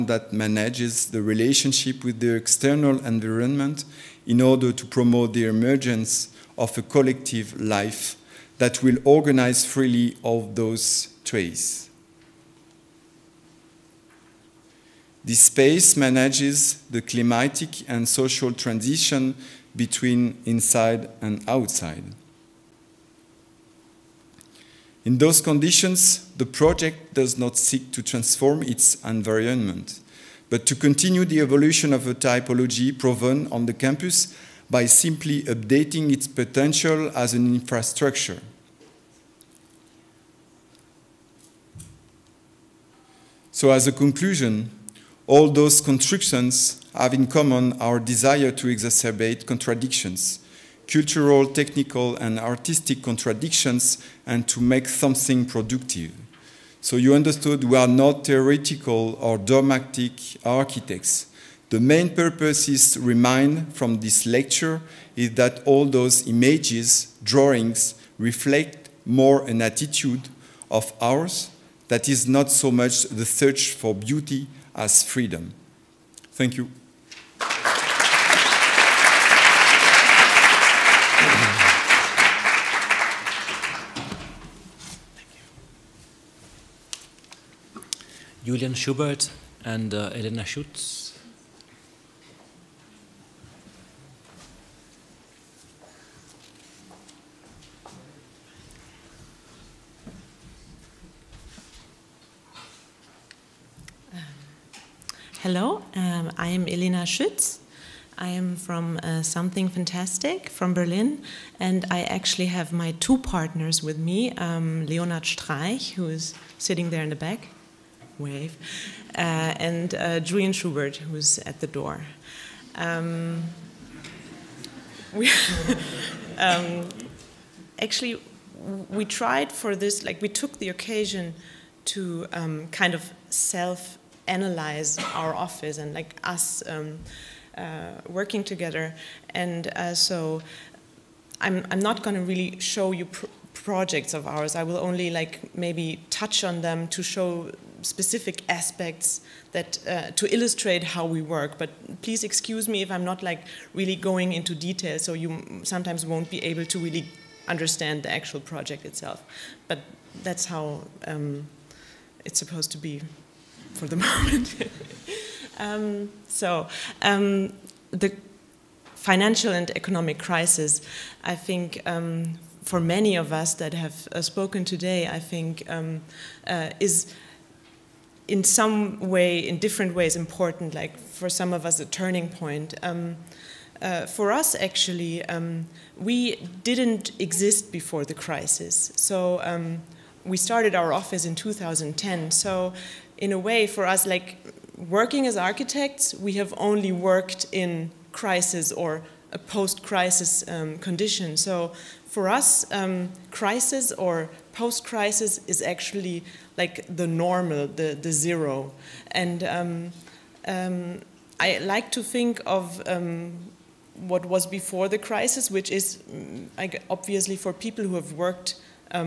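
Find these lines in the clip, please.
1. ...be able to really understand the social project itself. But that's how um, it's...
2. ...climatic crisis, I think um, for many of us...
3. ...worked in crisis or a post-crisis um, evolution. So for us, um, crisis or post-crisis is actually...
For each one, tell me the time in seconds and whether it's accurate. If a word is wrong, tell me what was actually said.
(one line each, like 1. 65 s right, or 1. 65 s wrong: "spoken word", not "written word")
1. 156 s wrong: "actual", not "social"
2. 169 s wrong: "economic", not "climatic"
3. 196 s wrong: "condition", not "evolution".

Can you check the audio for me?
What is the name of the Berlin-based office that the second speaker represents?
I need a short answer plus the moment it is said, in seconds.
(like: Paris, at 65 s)
Something Fantastic, at 109 s.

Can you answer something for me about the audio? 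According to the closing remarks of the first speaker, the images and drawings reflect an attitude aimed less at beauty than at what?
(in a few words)
Freedom.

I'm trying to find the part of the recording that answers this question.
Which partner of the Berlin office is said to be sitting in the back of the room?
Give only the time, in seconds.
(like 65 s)
114 s.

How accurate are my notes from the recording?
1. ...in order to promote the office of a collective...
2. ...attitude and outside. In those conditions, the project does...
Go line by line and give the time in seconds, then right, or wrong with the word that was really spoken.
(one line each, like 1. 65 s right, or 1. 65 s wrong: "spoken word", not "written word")
1. 4 s wrong: "emergence", not "office"
2. 20 s wrong: "inside", not "attitude".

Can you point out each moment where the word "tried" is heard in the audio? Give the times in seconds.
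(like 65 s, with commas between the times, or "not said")
129 s.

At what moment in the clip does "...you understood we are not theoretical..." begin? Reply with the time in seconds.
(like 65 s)
56 s.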